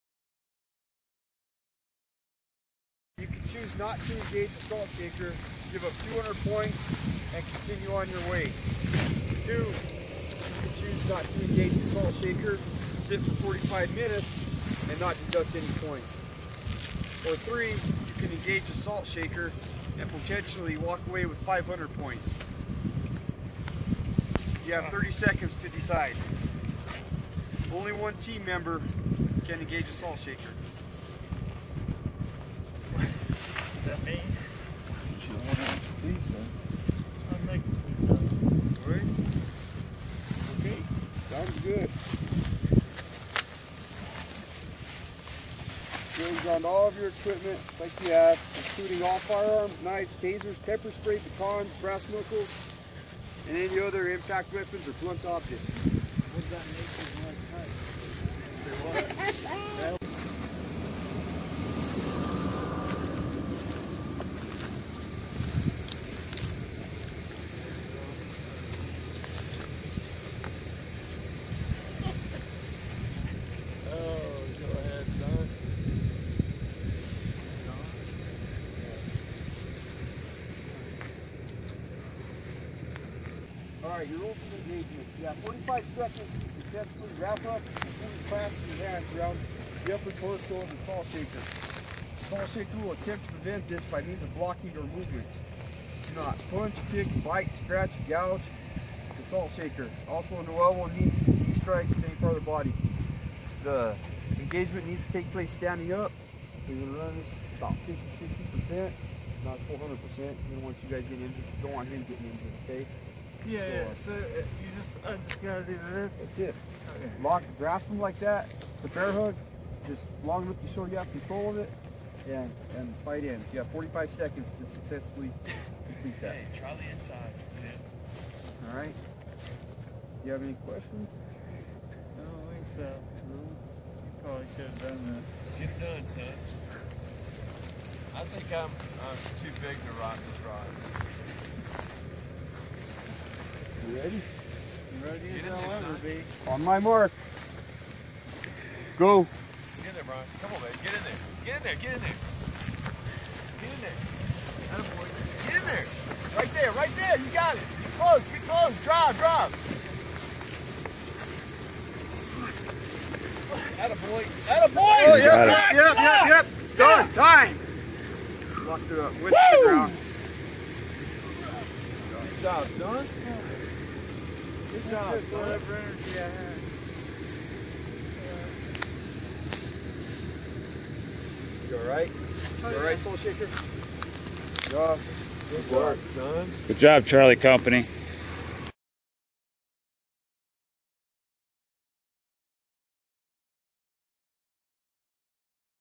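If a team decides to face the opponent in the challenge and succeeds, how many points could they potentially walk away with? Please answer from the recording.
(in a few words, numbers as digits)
500.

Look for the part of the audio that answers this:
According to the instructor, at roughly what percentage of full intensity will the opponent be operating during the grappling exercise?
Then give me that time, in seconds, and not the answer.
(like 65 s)
107 s.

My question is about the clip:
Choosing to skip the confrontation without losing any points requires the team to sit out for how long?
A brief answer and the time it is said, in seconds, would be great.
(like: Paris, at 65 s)
45 minutes, at 13 s.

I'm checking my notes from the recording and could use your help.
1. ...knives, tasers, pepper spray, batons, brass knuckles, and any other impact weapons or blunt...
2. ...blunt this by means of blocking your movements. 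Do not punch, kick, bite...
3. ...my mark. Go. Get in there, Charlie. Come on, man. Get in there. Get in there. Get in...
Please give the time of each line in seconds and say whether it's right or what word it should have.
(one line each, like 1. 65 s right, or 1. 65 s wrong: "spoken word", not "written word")
1. 49 s right
2. 93 s wrong: "prevent", not "blunt"
3. 146 s wrong: "Brian", not "Charlie".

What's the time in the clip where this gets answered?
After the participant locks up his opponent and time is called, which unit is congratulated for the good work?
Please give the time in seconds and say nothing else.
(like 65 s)
187 s.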